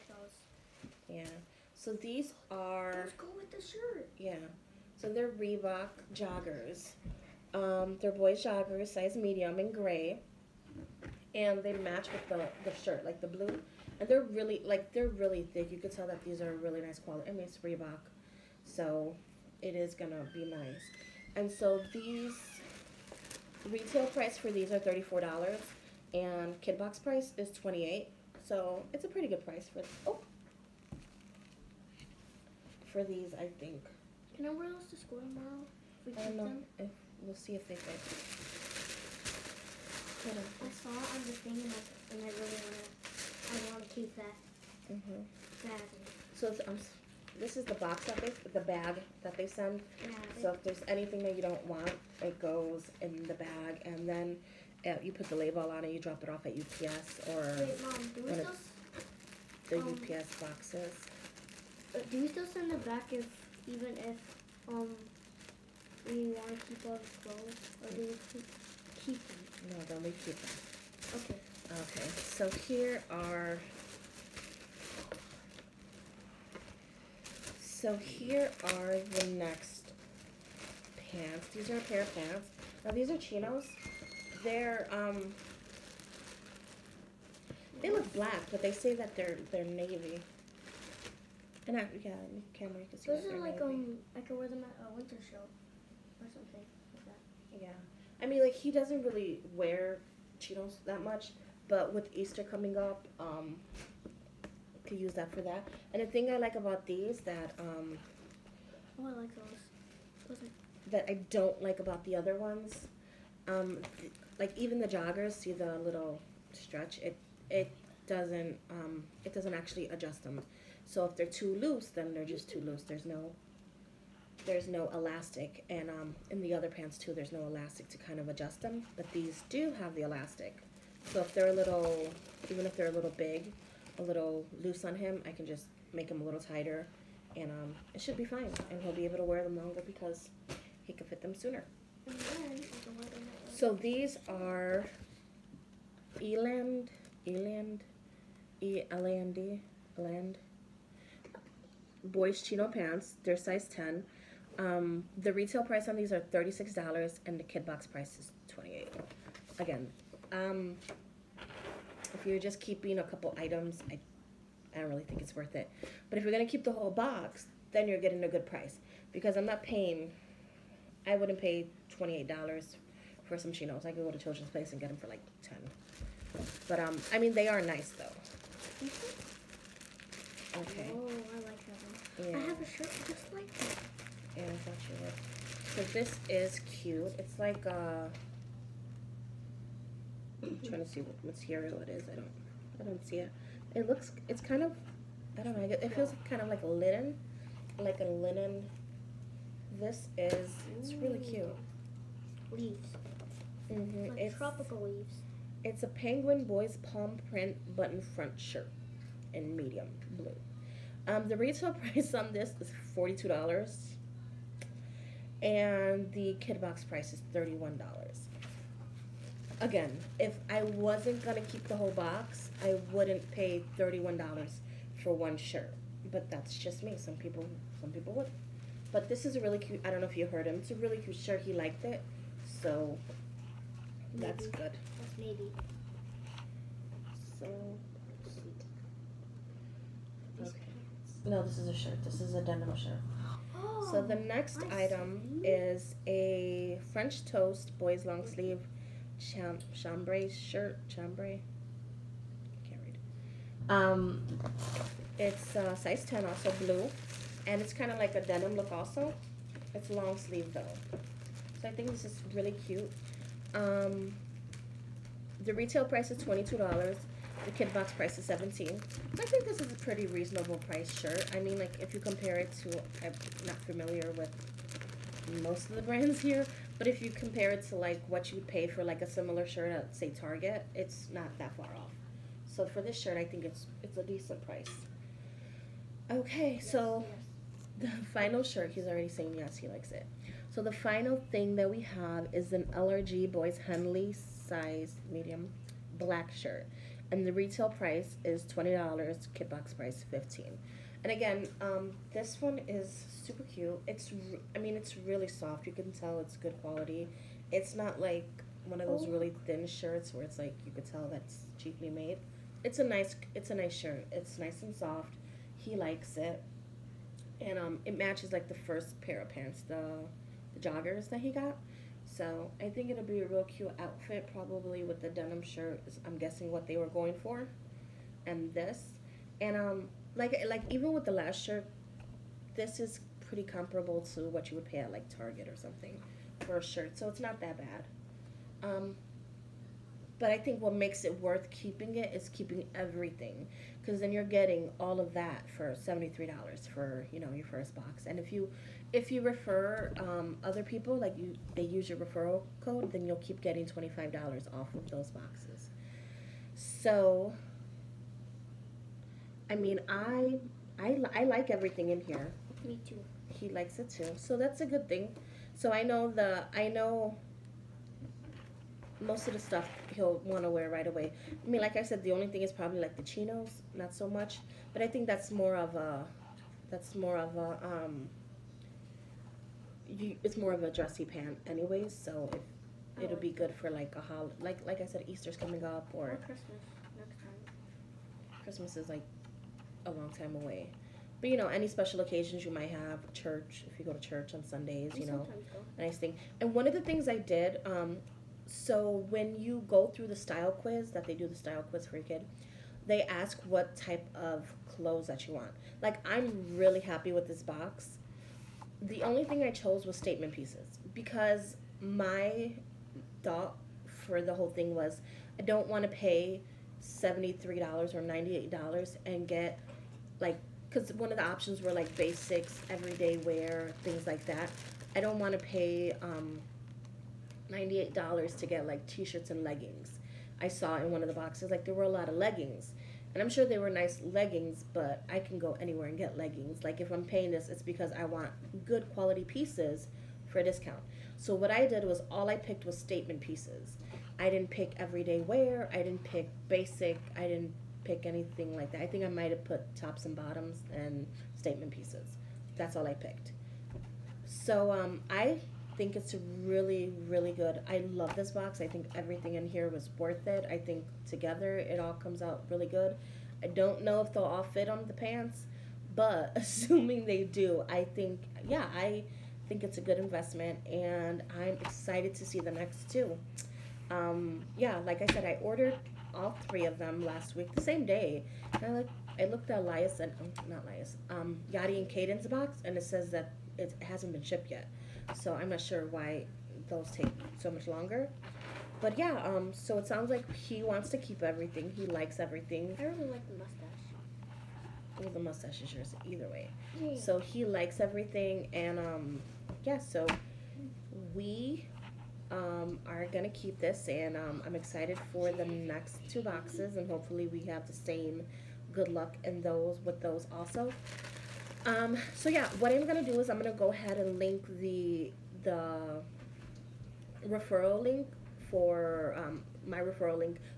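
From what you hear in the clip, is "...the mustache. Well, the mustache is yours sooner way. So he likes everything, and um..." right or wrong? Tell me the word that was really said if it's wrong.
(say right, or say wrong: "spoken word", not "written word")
wrong: "either", not "sooner".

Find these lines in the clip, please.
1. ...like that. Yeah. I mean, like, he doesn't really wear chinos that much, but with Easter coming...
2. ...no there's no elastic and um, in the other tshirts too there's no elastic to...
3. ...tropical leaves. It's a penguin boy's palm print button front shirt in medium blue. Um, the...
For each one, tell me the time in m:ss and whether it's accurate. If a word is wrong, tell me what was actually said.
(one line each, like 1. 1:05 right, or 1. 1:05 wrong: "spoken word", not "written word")
1. 1:36 right
2. 2:03 wrong: "pants", not "tshirts"
3. 3:24 right.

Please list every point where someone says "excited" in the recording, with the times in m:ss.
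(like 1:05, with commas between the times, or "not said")
7:51, 8:24.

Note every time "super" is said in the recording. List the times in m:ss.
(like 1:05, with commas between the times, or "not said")
5:03.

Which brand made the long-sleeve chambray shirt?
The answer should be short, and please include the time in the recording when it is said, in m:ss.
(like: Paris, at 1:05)
French Toast, at 4:06.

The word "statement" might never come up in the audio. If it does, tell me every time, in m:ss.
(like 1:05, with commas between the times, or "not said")
6:49, 7:22, 7:31.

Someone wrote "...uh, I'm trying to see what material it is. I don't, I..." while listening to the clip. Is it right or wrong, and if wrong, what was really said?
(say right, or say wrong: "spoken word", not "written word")
right.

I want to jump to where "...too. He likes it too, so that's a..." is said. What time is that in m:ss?
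6:02.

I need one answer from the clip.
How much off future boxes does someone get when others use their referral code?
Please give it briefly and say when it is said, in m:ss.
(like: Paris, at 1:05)
$25, at 5:53.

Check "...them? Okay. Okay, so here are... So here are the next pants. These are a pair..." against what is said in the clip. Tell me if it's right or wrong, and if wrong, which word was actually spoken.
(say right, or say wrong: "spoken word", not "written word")
right.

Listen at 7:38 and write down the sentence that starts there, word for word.
I think everything in here was worth it.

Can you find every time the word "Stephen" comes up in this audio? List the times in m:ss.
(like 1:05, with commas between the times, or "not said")
not said.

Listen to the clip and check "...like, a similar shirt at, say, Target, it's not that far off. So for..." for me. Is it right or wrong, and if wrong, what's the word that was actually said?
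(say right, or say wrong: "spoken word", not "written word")
right.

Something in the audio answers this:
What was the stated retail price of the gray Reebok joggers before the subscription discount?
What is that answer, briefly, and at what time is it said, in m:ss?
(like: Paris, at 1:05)
$34, at 0:24.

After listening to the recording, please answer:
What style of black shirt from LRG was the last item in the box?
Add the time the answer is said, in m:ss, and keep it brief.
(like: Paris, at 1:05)
Henley, at 4:53.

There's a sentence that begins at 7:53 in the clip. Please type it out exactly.
Um, yeah, like I said, I ordered all three of them last week, the same day.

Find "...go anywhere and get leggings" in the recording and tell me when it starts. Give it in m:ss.
7:15.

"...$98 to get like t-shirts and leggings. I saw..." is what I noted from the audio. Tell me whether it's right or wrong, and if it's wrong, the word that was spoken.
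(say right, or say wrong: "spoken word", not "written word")
right.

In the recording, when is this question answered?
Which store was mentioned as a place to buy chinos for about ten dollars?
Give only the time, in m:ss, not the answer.
2:54.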